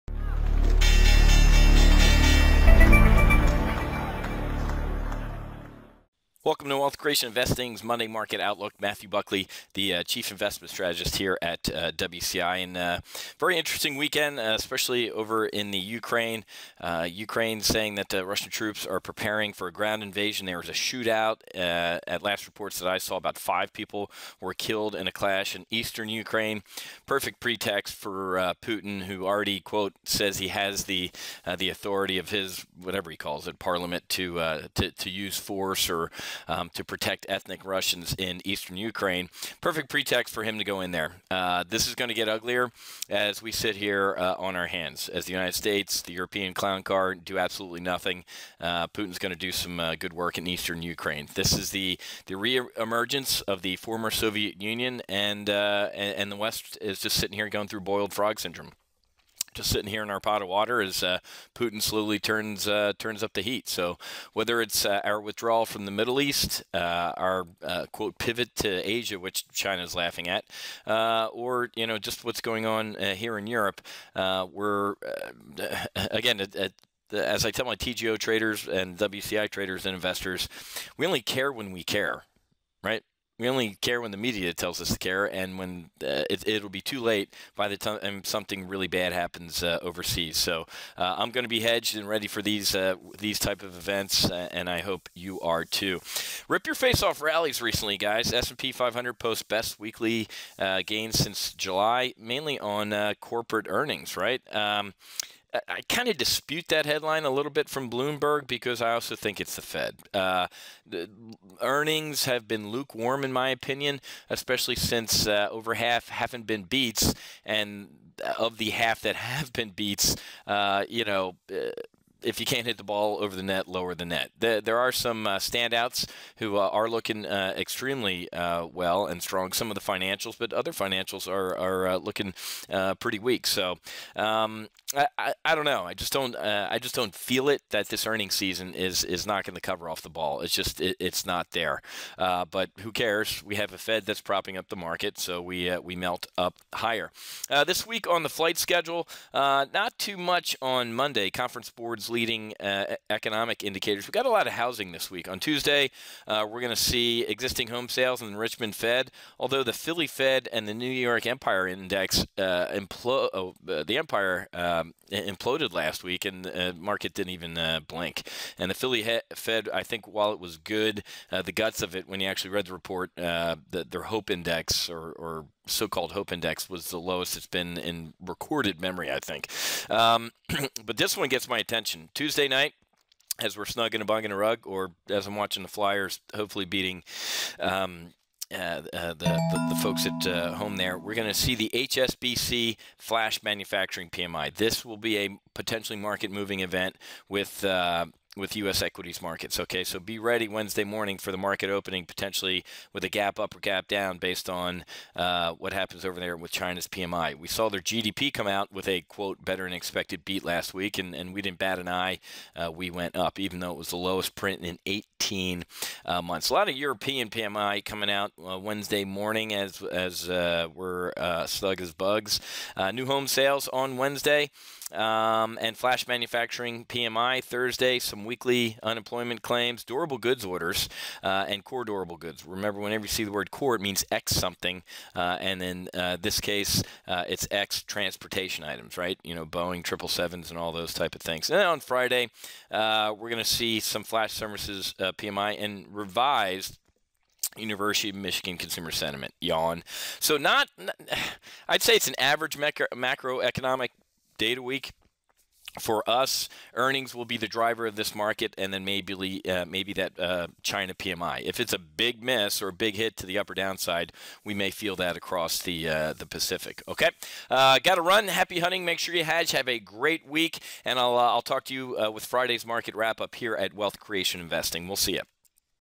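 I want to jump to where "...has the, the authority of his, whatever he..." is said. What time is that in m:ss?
0:30.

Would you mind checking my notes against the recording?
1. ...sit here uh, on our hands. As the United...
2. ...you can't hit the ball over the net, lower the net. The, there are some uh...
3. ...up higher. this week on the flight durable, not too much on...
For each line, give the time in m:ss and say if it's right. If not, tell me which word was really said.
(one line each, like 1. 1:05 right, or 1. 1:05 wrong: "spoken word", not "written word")
1. 0:43 right
2. 2:02 right
3. 2:26 wrong: "schedule", not "durable".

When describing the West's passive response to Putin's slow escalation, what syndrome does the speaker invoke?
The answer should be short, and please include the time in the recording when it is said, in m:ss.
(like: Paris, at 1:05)
boiled frog syndrome, at 0:57.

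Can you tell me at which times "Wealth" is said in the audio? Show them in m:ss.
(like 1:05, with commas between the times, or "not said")
0:06, 4:33.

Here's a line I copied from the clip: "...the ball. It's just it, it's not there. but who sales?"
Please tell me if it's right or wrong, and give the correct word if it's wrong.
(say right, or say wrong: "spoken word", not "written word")
wrong: "cares", not "sales".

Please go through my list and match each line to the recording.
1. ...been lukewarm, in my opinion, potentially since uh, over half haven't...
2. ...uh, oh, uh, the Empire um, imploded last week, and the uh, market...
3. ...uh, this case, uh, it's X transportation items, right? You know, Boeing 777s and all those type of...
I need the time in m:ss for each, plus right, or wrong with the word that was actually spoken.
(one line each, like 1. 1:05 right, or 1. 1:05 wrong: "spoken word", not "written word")
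1. 1:52 wrong: "especially", not "potentially"
2. 2:42 right
3. 3:55 right.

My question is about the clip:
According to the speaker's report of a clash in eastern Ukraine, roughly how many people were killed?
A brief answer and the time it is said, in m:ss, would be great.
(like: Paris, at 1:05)
5, at 0:23.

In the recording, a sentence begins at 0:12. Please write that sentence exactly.
And uh, very interesting weekend, uh, especially over in the Ukraine.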